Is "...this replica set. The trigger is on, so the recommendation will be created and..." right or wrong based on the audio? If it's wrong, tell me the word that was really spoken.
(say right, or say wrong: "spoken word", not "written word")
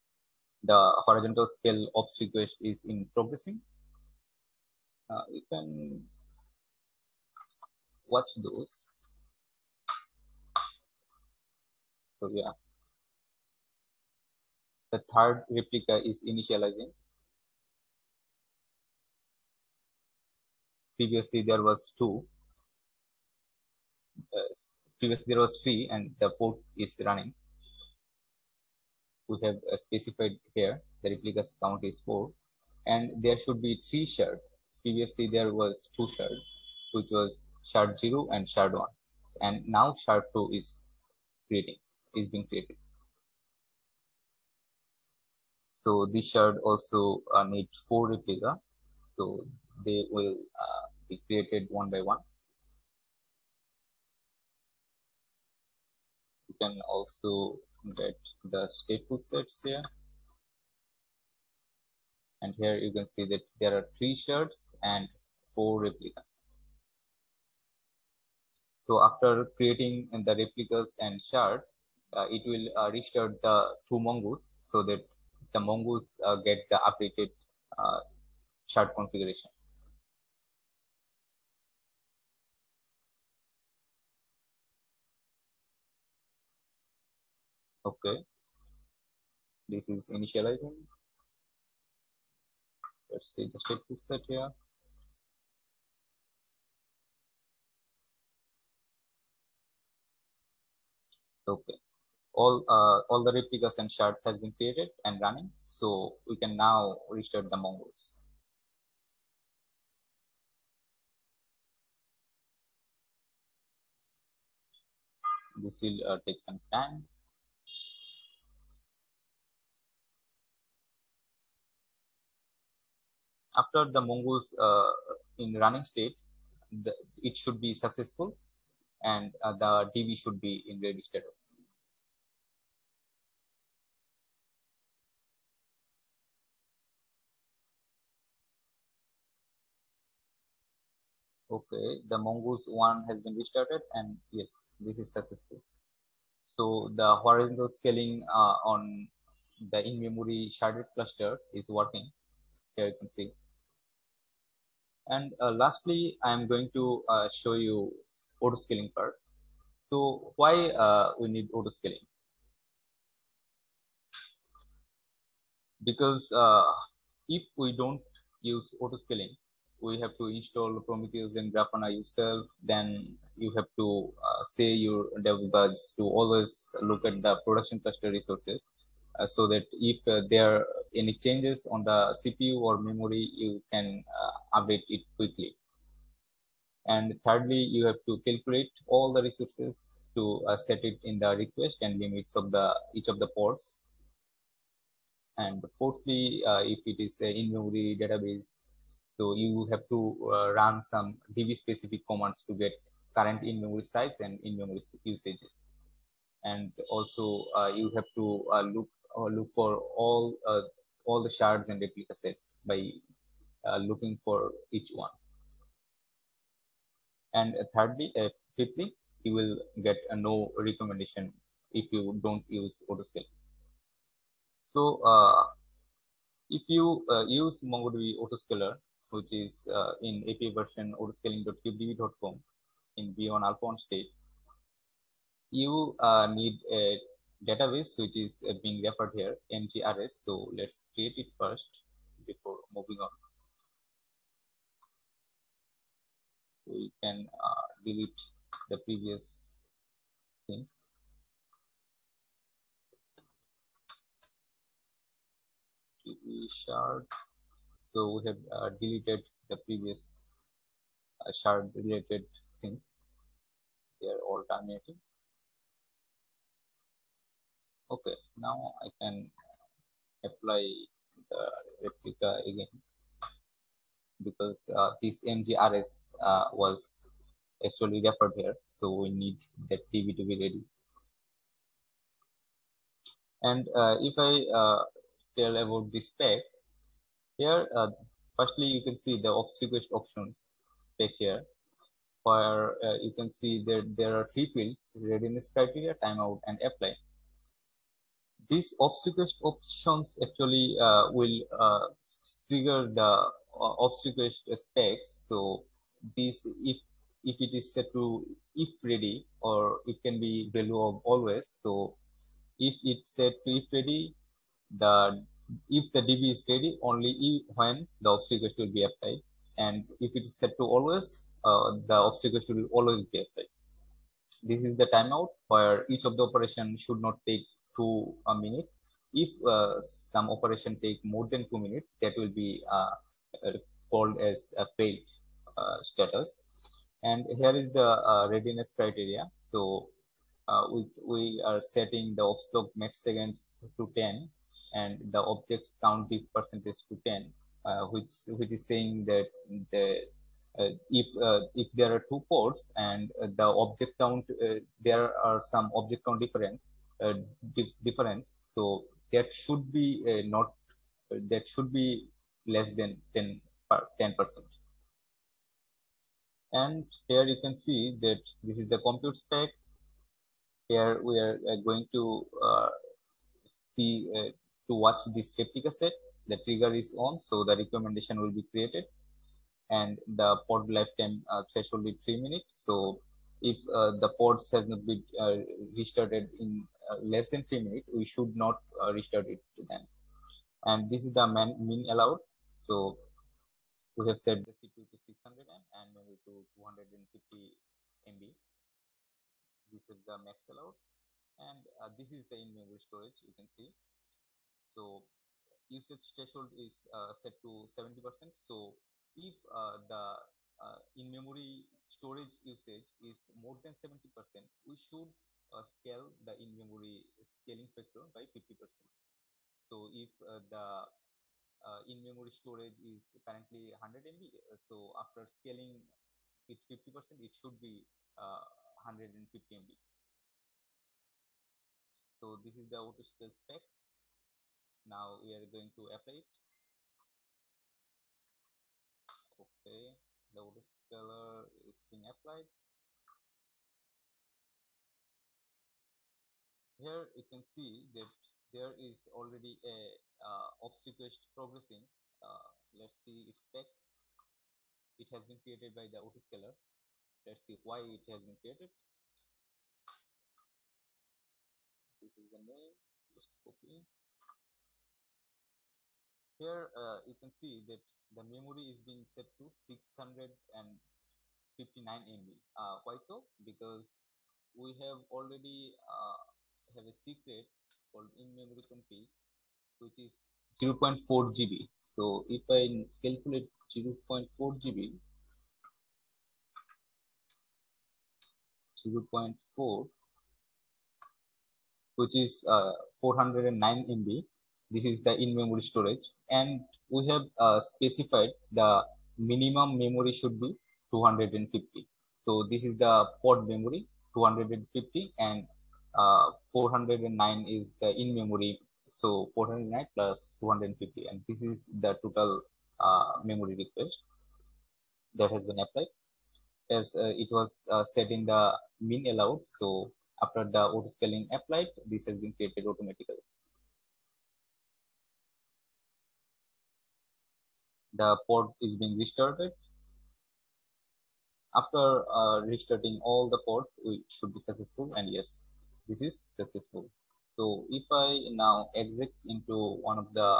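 right.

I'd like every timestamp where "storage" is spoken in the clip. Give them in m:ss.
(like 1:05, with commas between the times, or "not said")
6:42, 6:51, 7:02, 8:15.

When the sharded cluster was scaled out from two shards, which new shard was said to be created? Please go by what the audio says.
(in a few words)
shard two.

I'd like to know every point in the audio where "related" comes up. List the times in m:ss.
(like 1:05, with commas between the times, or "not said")
4:21.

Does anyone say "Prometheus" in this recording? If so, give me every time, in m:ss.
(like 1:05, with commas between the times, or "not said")
2:50.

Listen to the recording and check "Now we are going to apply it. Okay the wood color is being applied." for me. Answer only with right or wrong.
right.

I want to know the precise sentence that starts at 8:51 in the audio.
After uh, restarting all the pods, it should be successful.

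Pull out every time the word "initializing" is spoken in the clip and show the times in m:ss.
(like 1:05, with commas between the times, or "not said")
0:16, 1:30.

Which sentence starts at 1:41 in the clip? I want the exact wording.
Okay, all uh, all the replicas and shards have been created and running, so we can now restart the Mongols.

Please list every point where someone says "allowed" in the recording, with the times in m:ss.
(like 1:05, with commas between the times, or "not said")
6:31, 6:40, 8:39.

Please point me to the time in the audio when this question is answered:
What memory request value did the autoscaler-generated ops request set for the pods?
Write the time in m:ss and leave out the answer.
7:49.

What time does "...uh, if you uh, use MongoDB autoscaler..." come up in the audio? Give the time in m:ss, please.
3:45.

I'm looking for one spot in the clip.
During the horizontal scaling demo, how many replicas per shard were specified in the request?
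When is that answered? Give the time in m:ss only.
0:31.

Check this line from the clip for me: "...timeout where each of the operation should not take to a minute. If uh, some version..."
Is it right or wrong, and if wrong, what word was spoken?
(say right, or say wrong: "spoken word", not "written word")
wrong: "operation", not "version".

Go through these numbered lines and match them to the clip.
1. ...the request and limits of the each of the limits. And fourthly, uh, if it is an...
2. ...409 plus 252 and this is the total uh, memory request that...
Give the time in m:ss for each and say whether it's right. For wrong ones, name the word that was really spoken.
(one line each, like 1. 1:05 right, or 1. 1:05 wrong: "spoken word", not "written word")
1. 3:11 wrong: "ports", not "limits"
2. 8:29 wrong: "250", not "252".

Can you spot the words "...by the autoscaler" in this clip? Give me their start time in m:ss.
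7:35.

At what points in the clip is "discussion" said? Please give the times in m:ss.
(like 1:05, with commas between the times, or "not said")
not said.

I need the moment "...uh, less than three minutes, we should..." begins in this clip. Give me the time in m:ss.
6:26.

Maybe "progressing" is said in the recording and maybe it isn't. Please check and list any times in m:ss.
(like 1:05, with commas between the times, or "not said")
0:03, 7:31.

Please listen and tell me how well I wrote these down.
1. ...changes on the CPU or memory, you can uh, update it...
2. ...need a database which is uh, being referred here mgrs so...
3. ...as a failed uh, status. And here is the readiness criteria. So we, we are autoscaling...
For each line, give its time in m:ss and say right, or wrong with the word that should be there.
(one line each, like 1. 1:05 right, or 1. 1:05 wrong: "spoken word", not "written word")
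1. 3:01 right
2. 3:56 right
3. 5:34 wrong: "setting", not "autoscaling".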